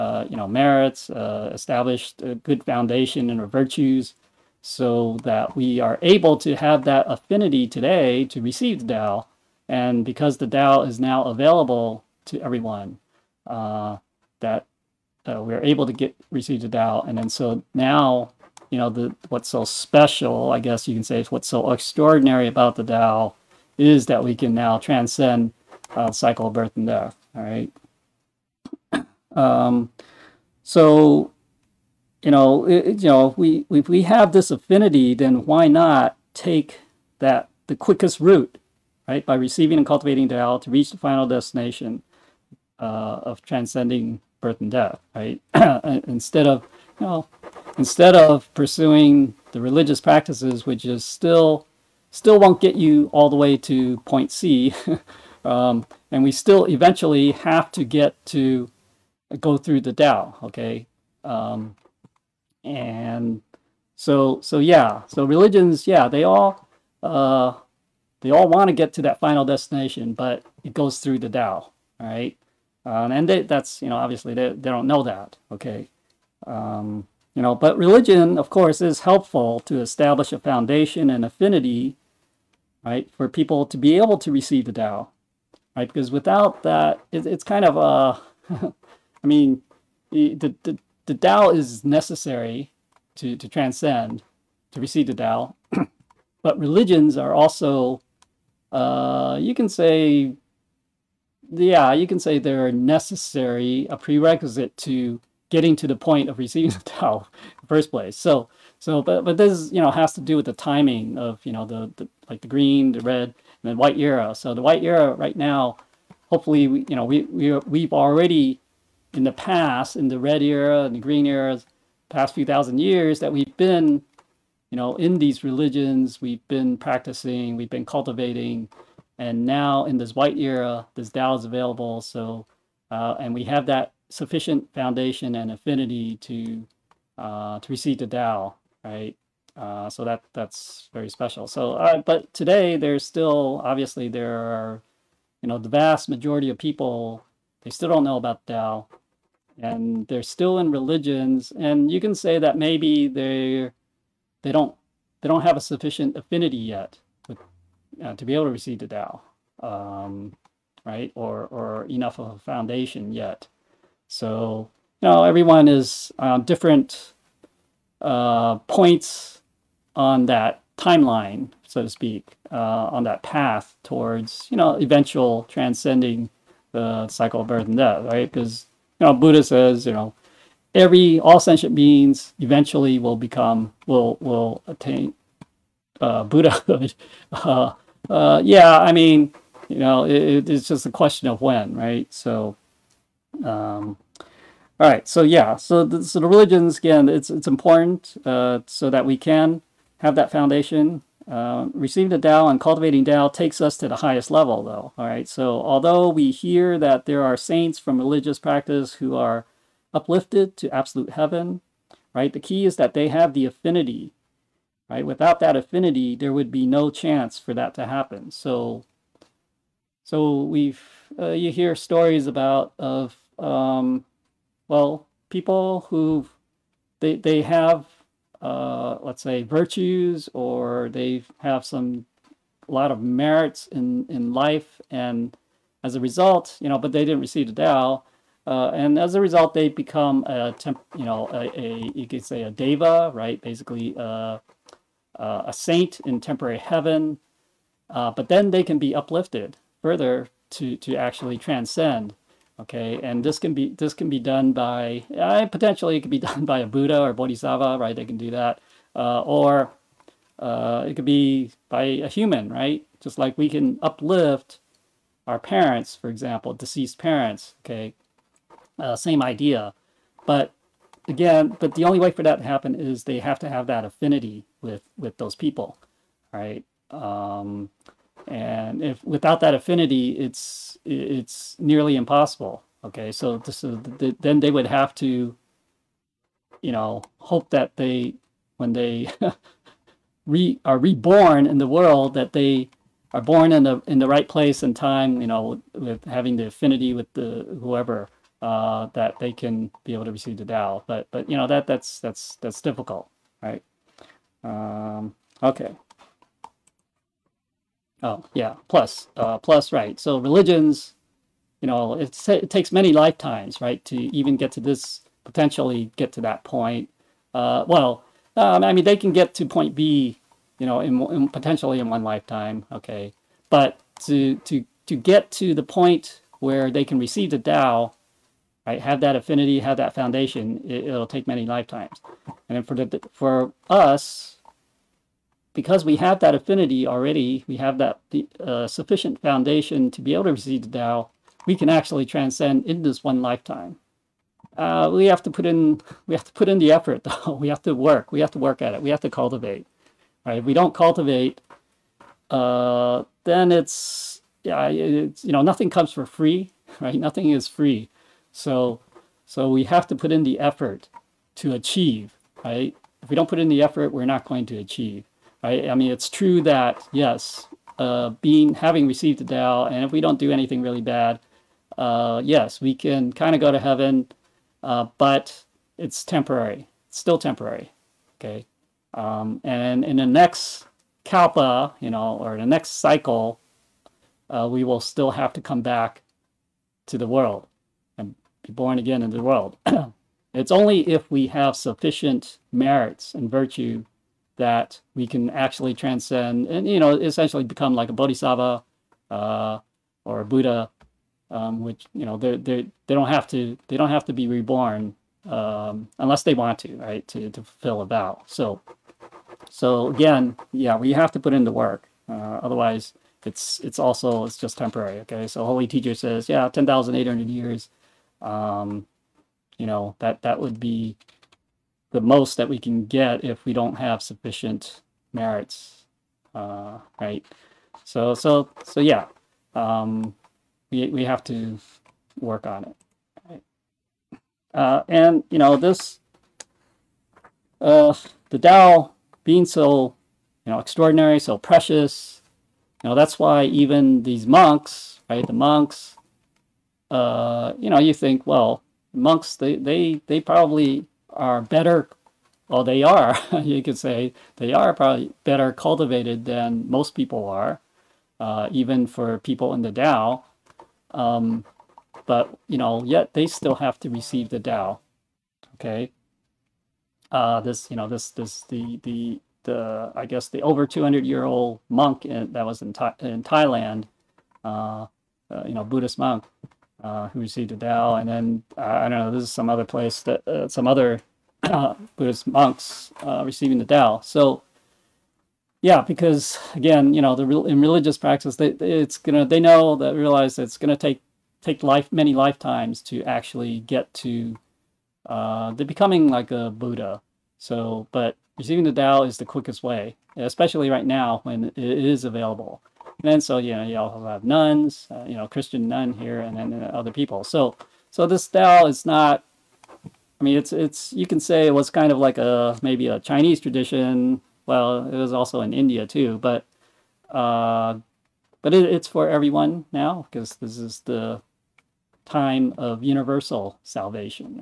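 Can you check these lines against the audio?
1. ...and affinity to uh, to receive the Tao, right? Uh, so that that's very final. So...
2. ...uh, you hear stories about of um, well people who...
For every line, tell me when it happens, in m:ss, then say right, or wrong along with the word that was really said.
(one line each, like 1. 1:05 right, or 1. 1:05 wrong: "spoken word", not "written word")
1. 2:15 wrong: "special", not "final"
2. 3:41 right.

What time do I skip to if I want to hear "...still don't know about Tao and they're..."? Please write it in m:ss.
2:27.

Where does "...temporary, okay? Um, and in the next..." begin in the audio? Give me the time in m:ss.
6:17.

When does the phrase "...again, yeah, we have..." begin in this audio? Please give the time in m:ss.
6:49.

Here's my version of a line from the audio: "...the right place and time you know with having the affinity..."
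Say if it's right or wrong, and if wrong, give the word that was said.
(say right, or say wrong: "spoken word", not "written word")
right.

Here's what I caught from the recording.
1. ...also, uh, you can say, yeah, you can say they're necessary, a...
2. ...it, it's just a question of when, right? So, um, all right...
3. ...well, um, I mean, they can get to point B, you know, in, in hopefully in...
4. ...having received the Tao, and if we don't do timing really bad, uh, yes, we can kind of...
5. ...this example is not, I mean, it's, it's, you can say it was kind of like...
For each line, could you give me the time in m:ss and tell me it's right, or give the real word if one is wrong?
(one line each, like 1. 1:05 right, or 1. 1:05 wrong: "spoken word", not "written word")
1. 1:37 right
2. 3:10 right
3. 5:17 wrong: "potentially", not "hopefully"
4. 6:08 wrong: "anything", not "timing"
5. 8:28 wrong: "style", not "example".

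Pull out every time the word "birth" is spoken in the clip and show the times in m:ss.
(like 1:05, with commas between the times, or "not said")
0:26, 0:44, 2:57.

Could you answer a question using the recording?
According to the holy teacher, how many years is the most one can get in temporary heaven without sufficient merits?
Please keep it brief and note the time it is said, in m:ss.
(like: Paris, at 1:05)
10,800, at 6:56.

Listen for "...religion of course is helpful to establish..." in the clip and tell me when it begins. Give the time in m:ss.
1:17.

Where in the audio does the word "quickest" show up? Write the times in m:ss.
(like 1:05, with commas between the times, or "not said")
0:37, 8:19.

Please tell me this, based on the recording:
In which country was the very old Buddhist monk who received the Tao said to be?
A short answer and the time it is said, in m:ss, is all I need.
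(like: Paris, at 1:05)
Thailand, at 7:53.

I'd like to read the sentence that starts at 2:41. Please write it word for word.
Or or enough of a foundation yet.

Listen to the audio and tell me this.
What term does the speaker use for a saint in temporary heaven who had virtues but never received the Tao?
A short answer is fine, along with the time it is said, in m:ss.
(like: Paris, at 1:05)
Deva, at 4:02.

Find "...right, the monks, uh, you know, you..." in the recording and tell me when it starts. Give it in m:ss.
7:25.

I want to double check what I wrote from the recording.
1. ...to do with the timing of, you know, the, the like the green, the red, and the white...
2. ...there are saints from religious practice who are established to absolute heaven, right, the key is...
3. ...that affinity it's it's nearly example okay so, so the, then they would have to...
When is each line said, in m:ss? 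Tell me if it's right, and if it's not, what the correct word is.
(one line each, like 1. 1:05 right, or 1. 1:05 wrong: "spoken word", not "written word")
1. 1:50 right
2. 3:27 wrong: "uplifted", not "established"
3. 4:39 wrong: "impossible", not "example".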